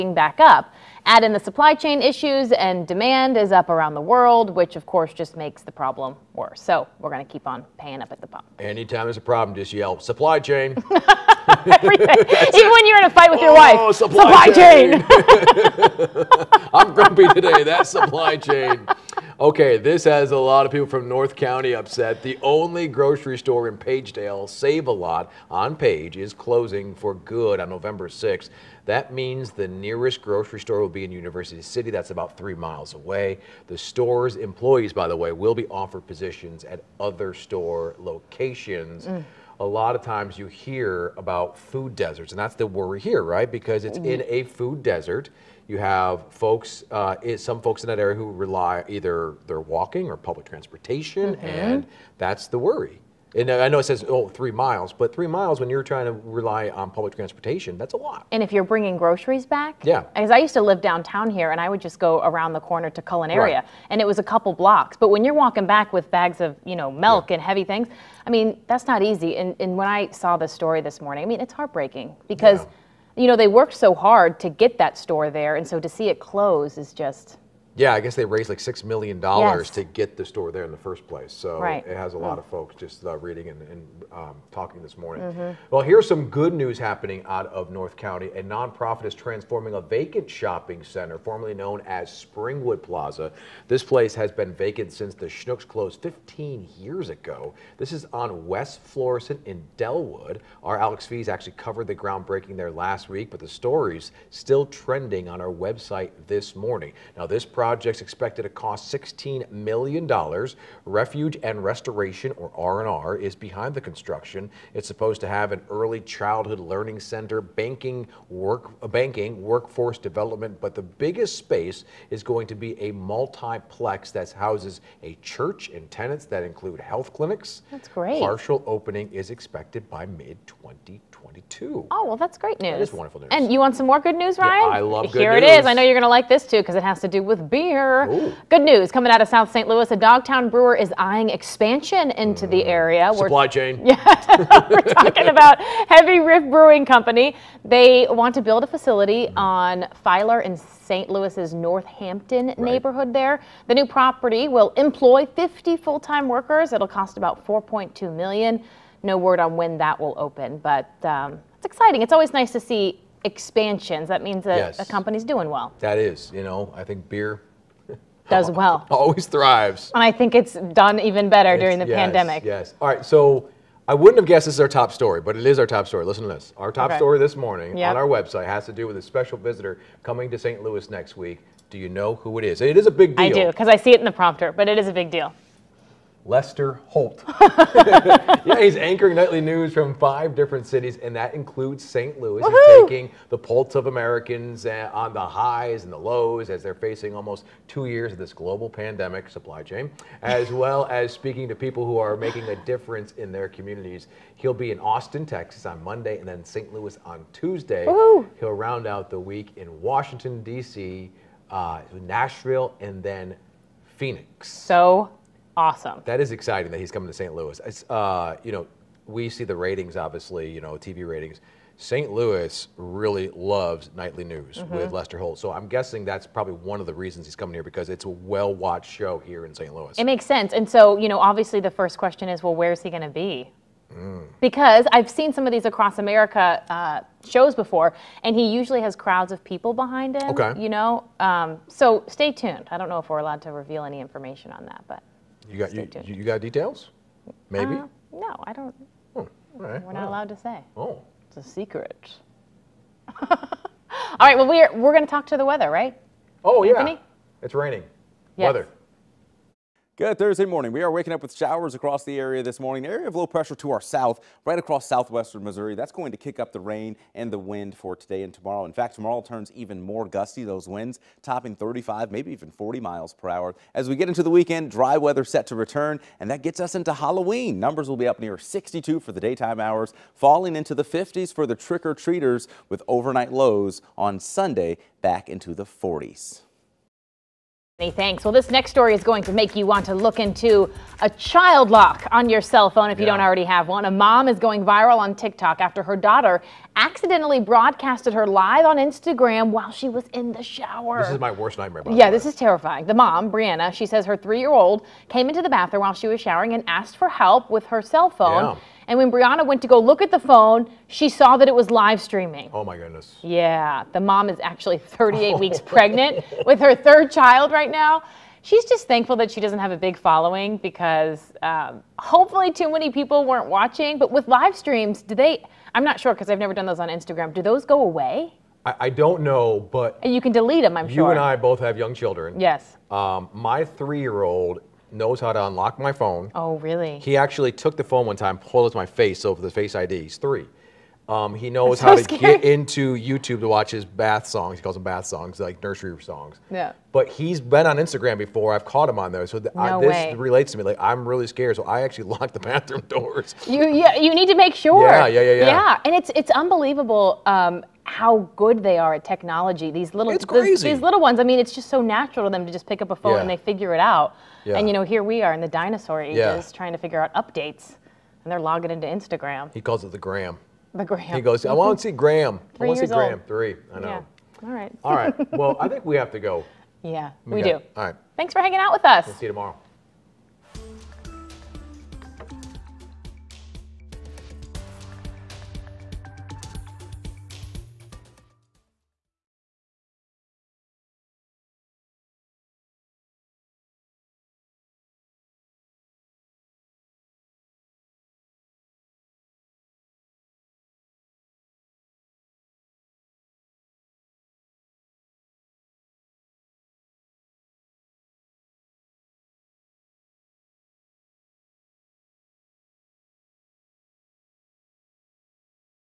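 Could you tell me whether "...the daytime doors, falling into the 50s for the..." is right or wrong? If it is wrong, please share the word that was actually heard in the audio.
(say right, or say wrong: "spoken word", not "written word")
wrong: "hours", not "doors".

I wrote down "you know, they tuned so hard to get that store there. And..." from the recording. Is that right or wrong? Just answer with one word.
wrong.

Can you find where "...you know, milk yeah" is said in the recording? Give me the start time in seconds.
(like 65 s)
66 s.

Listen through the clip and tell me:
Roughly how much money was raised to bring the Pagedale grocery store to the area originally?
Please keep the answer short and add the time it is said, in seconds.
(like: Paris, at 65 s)
6 million dollars, at 78 s.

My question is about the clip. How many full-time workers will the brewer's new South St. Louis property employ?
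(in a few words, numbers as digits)
50.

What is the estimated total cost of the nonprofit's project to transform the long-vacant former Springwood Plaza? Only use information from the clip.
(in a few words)
$16 million.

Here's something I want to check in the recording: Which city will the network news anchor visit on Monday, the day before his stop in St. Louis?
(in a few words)
Austin, Texas.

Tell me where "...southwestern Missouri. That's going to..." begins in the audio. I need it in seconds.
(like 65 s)
264 s.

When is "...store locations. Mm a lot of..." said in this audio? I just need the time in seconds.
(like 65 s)
37 s.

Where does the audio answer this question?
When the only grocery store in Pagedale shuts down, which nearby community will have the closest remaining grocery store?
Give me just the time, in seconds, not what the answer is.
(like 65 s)
31 s.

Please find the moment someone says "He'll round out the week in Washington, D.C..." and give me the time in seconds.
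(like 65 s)
208 s.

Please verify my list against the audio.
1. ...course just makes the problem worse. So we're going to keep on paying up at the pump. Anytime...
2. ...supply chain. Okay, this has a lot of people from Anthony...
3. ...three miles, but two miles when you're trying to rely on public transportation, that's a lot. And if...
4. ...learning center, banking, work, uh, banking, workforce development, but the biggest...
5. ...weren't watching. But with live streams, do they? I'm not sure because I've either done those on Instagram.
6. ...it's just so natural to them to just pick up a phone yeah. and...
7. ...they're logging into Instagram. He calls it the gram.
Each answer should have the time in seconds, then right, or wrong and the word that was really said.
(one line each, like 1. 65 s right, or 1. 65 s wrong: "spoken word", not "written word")
1. 4 s right
2. 17 s wrong: "North", not "Anthony"
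3. 54 s wrong: "three", not "two"
4. 116 s right
5. 323 s wrong: "never", not "either"
6. 361 s right
7. 368 s right.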